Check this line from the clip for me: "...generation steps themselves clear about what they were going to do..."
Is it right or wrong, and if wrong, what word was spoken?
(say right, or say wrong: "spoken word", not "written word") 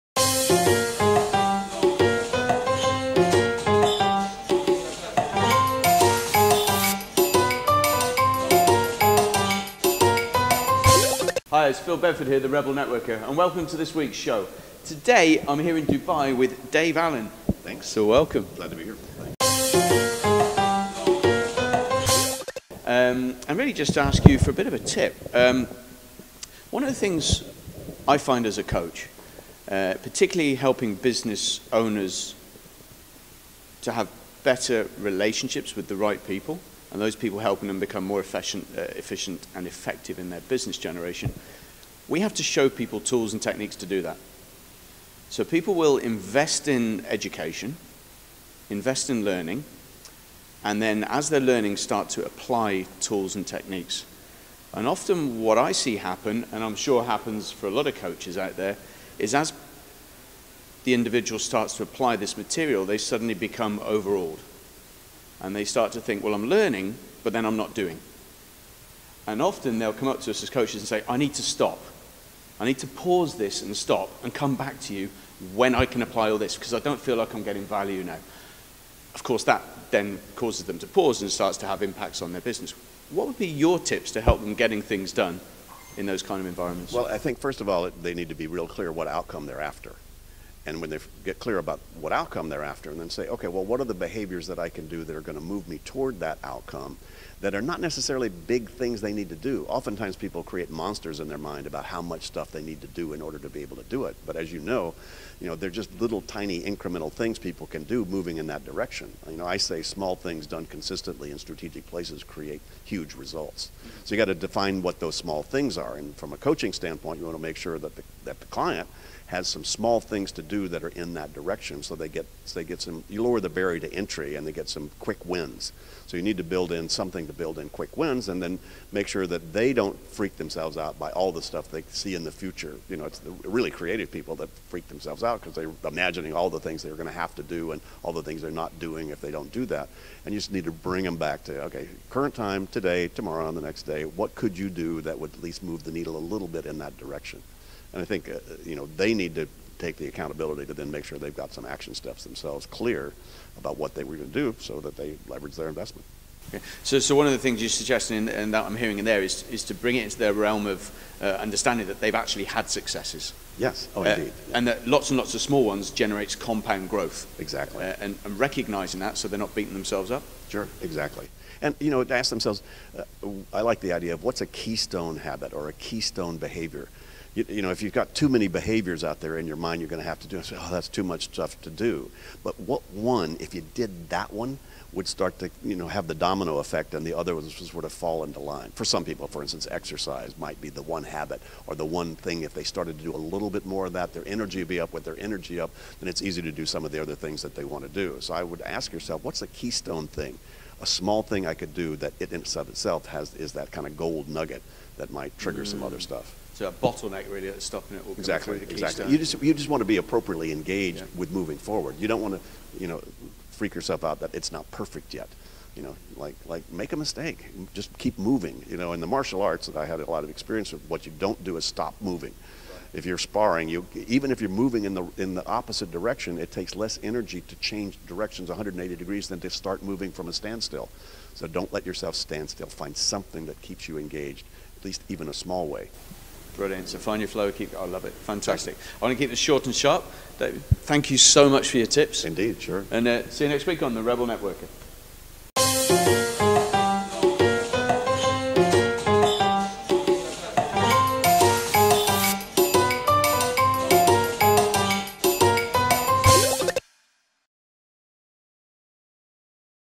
wrong: "action", not "generation".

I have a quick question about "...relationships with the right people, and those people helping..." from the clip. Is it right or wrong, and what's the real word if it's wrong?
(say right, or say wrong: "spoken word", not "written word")
right.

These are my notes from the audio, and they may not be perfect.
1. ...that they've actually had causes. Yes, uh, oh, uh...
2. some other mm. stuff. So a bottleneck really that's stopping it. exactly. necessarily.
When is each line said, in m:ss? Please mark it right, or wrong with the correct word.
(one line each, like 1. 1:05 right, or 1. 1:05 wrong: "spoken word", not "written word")
1. 2:41 wrong: "successes", not "causes"
2. 3:25 wrong: "exactly", not "necessarily".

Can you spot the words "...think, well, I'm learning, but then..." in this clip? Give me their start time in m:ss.
1:06.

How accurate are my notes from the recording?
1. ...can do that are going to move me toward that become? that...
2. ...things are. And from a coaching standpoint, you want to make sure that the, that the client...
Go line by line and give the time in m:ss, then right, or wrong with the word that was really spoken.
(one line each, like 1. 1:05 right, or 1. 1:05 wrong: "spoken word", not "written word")
1. 1:34 wrong: "outcome", not "become"
2. 1:55 right.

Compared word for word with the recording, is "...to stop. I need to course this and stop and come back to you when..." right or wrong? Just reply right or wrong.
wrong.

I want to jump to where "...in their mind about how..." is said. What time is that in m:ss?
1:41.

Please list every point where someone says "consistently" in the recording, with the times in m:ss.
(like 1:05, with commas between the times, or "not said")
1:50.